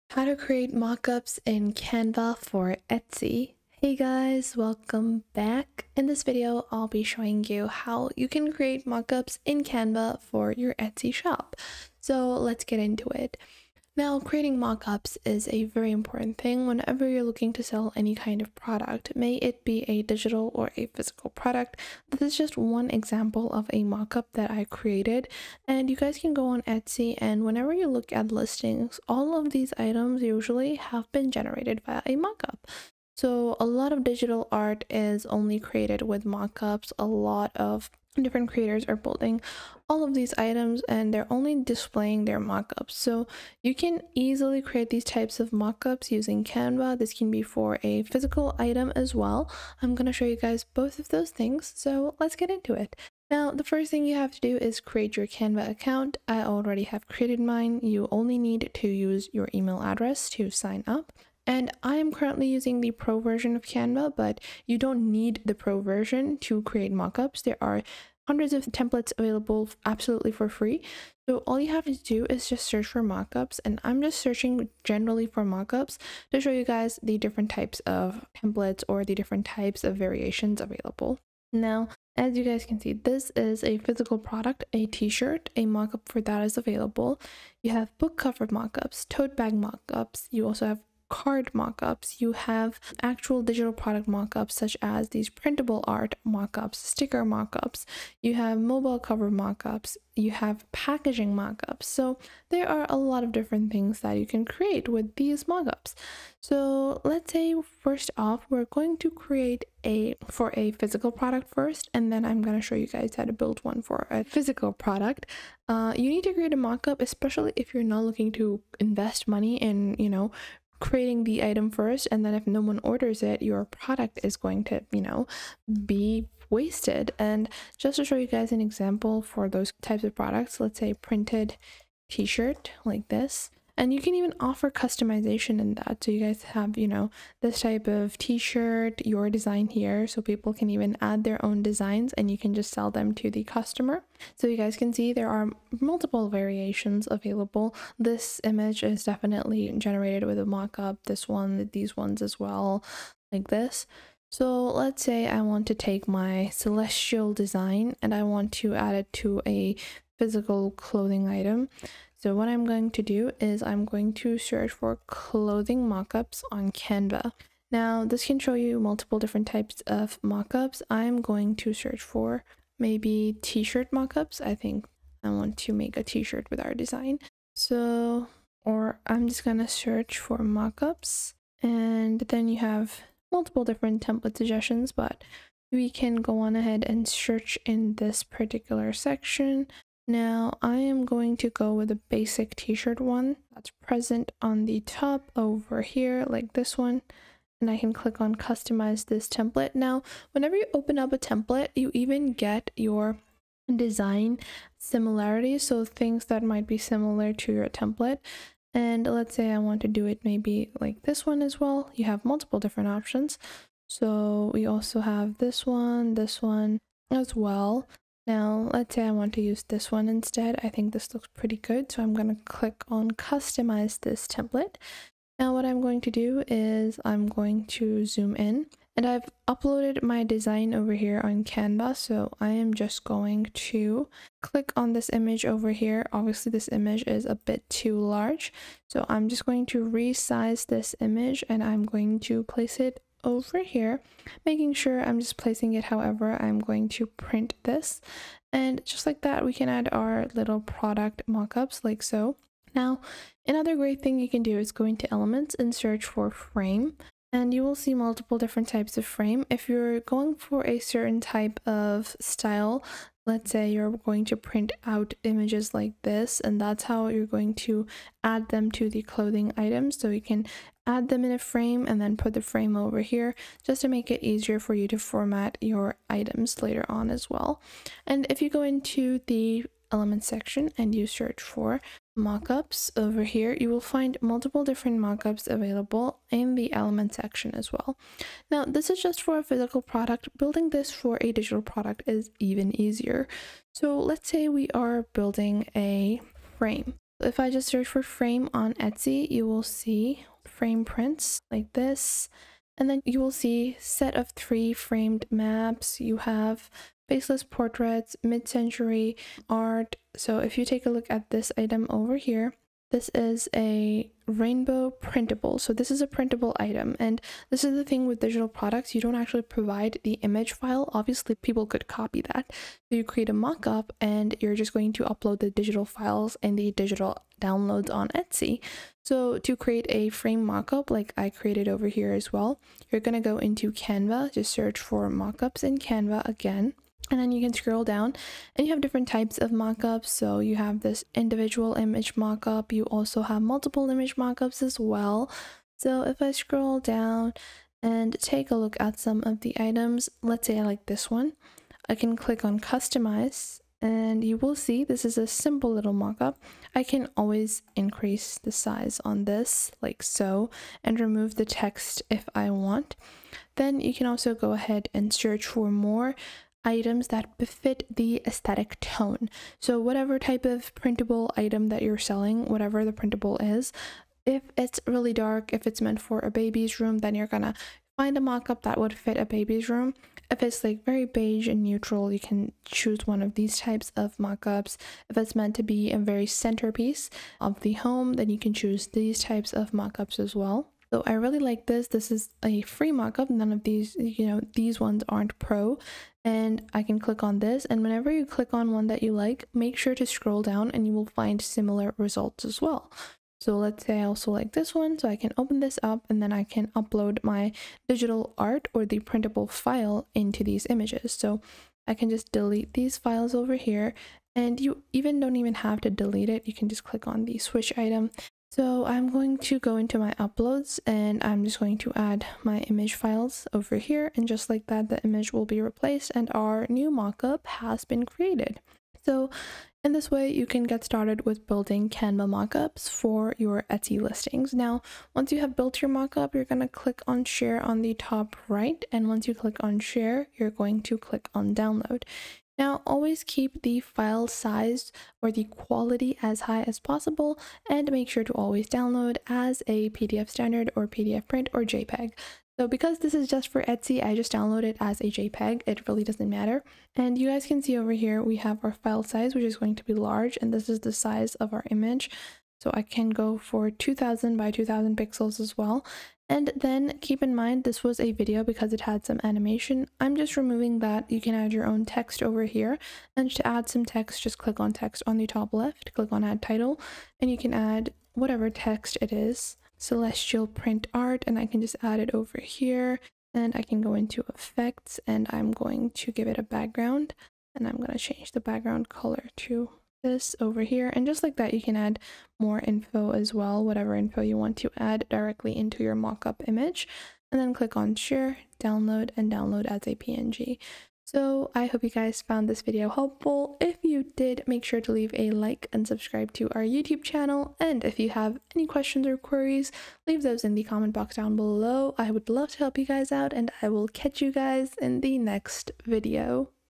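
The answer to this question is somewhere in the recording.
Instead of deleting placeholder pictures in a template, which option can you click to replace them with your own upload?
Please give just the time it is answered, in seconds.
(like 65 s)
417 s.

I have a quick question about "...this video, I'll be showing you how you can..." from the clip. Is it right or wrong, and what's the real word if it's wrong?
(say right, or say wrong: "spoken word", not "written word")
right.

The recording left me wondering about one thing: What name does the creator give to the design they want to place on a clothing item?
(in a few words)
celestial design.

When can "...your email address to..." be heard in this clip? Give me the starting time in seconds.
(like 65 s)
59 s.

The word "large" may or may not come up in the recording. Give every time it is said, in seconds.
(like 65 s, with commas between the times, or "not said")
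237 s, 459 s.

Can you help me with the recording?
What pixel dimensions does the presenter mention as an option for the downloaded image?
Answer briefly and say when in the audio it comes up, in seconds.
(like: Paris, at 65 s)
2000 by 2000, at 463 s.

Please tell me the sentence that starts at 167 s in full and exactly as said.
Now this can show you multiple different types of mockups.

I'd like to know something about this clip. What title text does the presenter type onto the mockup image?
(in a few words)
Celestial print art.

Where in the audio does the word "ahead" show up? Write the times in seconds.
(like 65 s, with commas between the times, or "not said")
186 s, 364 s.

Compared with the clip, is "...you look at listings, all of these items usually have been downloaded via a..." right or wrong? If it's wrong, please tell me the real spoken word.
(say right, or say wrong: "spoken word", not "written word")
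wrong: "generated", not "downloaded".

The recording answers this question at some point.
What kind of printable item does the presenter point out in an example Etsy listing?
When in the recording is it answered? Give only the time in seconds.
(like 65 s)
314 s.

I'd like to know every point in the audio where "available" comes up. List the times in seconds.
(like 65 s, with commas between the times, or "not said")
69 s, 80 s, 86 s, 147 s, 285 s.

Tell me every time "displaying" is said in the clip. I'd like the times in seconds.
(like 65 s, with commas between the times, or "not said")
41 s.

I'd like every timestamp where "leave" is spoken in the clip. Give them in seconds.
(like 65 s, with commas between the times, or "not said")
504 s, 510 s.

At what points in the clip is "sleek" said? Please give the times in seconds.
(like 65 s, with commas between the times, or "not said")
not said.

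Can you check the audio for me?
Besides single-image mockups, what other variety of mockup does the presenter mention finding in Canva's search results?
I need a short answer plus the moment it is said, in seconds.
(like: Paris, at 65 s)
multiple image mockups, at 343 s.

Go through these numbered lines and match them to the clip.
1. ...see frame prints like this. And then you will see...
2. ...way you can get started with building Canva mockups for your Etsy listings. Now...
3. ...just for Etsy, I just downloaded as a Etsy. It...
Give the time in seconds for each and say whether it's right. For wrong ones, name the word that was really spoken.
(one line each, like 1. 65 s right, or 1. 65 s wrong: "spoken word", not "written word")
1. 299 s right
2. 430 s right
3. 453 s wrong: "JPEG", not "Etsy".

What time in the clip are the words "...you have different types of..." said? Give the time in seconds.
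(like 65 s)
338 s.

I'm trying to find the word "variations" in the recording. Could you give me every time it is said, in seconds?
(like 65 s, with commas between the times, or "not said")
79 s, 146 s.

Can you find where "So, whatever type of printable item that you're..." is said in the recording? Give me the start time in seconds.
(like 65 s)
369 s.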